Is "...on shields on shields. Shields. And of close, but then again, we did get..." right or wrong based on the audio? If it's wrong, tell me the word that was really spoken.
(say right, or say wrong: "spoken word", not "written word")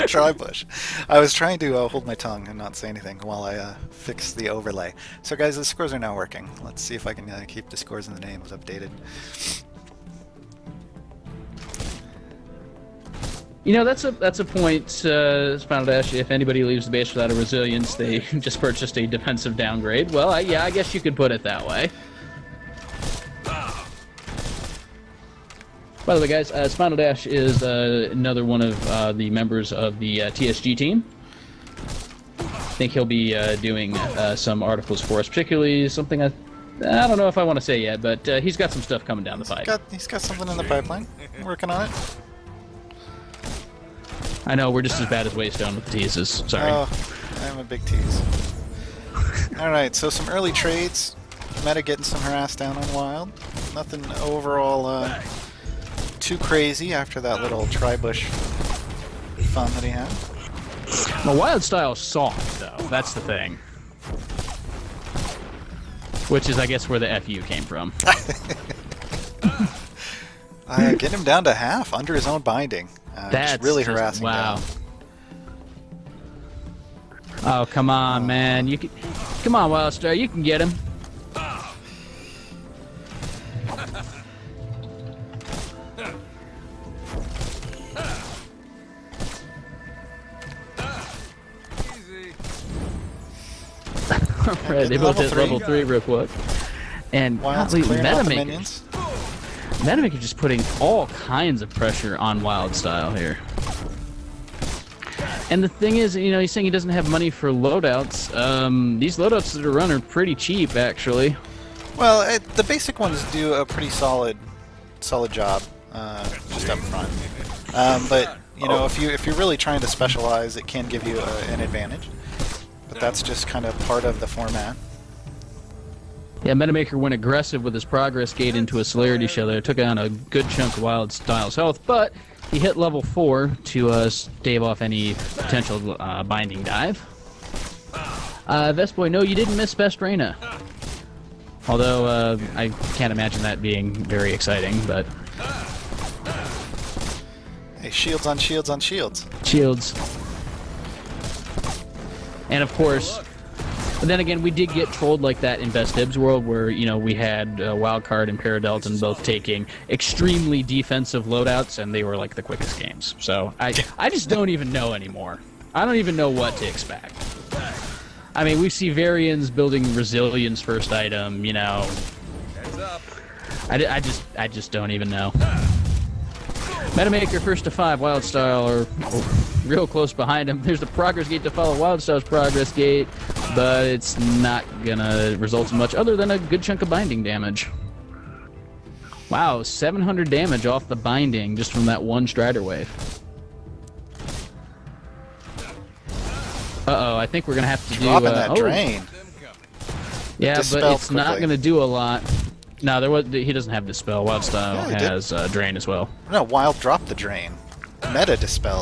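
wrong: "course", not "close".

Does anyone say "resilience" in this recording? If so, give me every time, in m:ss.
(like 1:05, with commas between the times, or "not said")
0:17, 2:49.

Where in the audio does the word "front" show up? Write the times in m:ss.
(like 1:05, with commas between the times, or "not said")
1:56.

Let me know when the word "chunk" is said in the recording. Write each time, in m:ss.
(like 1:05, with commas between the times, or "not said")
2:10, 3:06.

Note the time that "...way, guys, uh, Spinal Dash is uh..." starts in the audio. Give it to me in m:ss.
0:26.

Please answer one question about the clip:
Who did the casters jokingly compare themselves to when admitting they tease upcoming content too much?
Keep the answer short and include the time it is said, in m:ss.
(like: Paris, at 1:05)
Waystone, at 0:45.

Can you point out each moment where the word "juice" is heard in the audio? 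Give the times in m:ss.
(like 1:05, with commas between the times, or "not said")
not said.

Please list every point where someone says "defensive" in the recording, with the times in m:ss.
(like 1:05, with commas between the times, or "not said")
0:19, 2:40.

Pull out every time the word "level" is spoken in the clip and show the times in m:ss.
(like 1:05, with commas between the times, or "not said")
1:35, 2:12.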